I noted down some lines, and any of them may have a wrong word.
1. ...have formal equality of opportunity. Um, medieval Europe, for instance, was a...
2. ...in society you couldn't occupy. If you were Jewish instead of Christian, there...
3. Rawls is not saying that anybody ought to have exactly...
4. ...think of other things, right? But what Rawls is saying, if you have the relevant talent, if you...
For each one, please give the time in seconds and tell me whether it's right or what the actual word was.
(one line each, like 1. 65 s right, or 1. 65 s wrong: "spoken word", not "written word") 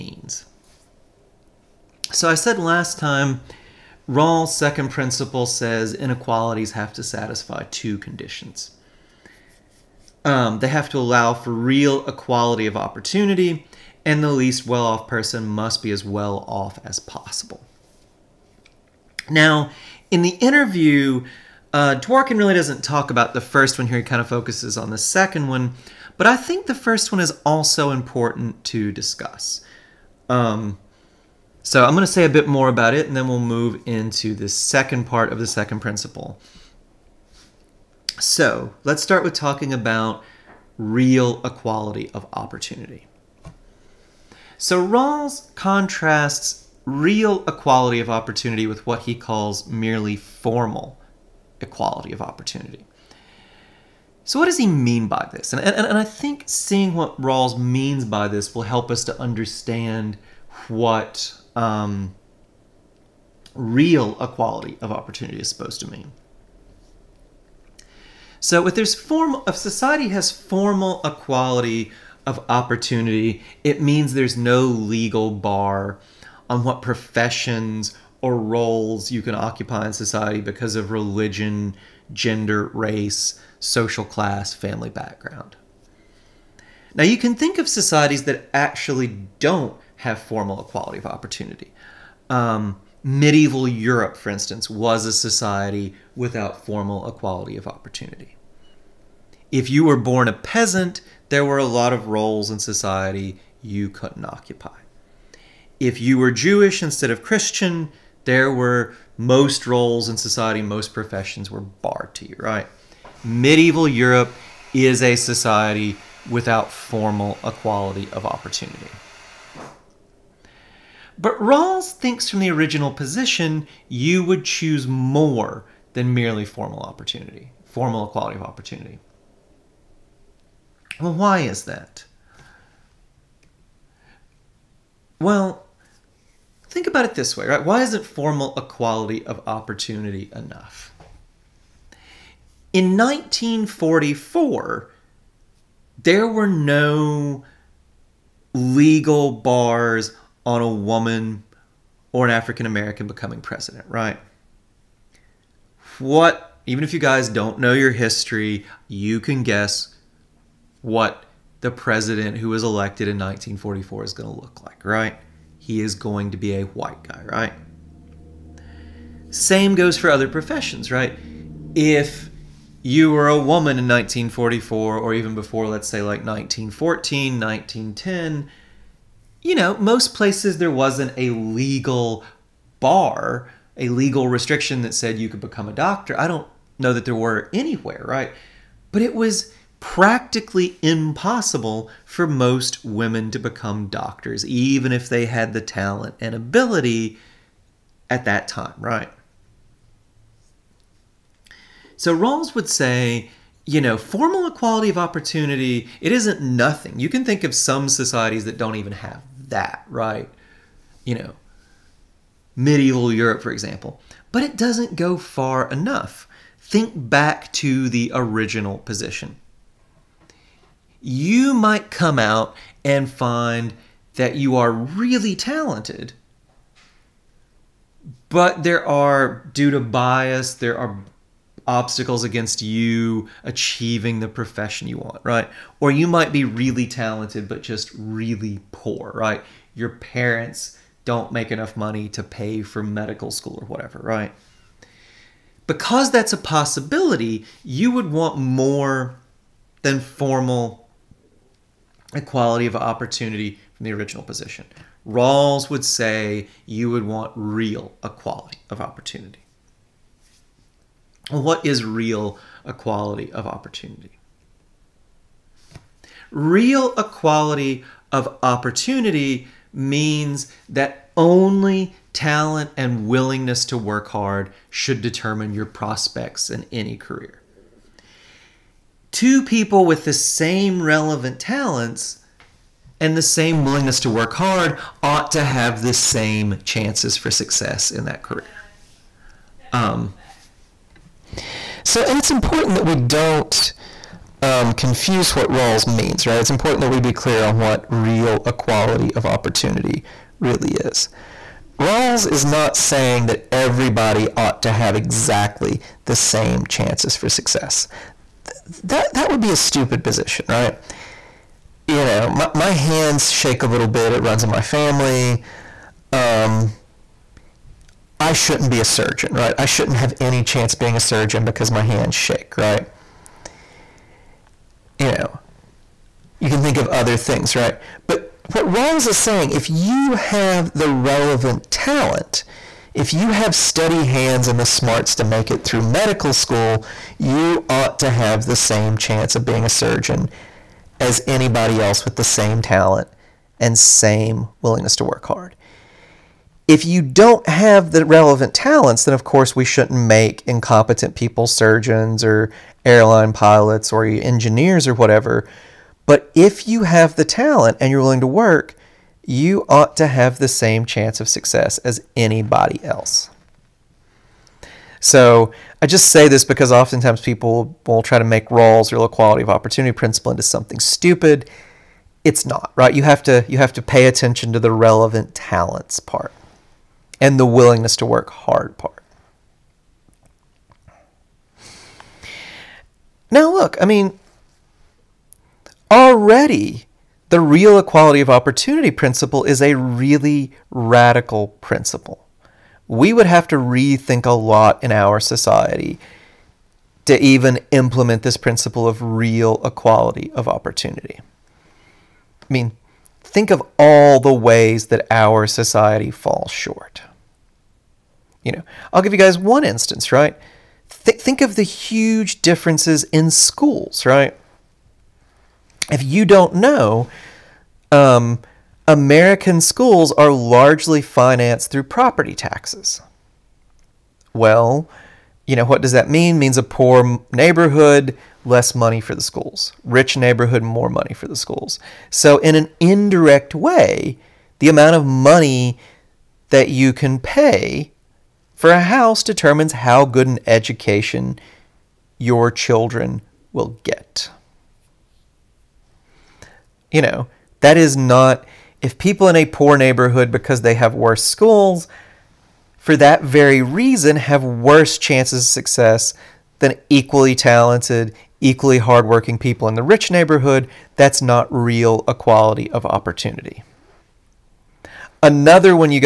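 1. 89 s right
2. 102 s right
3. 301 s wrong: "everybody", not "anybody"
4. 326 s right.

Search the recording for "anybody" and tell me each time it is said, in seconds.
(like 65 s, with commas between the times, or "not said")
341 s, 362 s.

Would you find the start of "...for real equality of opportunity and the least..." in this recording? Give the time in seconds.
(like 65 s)
11 s.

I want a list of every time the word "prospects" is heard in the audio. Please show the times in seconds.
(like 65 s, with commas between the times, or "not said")
275 s.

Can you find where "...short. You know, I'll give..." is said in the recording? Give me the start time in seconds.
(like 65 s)
406 s.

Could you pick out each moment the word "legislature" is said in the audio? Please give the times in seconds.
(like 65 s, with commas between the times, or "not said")
not said.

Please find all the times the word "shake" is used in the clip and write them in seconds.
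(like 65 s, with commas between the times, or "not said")
313 s, 322 s.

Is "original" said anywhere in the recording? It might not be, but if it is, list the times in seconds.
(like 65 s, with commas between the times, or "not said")
122 s, 218 s, 253 s.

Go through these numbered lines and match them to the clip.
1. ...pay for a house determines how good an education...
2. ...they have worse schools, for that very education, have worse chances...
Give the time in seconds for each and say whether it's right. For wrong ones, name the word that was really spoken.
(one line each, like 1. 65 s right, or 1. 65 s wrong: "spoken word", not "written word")
1. 437 s right
2. 450 s wrong: "reason", not "education".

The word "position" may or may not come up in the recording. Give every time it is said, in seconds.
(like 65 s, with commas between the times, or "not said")
122 s, 218 s, 254 s, 310 s.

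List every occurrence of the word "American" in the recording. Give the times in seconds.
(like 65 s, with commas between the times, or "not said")
152 s, 418 s.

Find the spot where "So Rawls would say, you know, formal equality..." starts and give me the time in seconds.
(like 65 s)
201 s.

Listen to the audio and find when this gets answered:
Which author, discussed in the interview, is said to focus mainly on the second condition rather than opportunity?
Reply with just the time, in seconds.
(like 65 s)
22 s.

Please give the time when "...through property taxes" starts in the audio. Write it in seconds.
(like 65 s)
421 s.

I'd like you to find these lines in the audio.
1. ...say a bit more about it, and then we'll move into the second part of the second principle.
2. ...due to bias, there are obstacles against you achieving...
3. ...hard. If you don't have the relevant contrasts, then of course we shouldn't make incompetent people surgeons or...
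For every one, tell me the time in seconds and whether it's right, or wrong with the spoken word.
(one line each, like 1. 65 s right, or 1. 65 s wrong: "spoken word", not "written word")
1. 32 s right
2. 229 s right
3. 345 s wrong: "talents", not "contrasts".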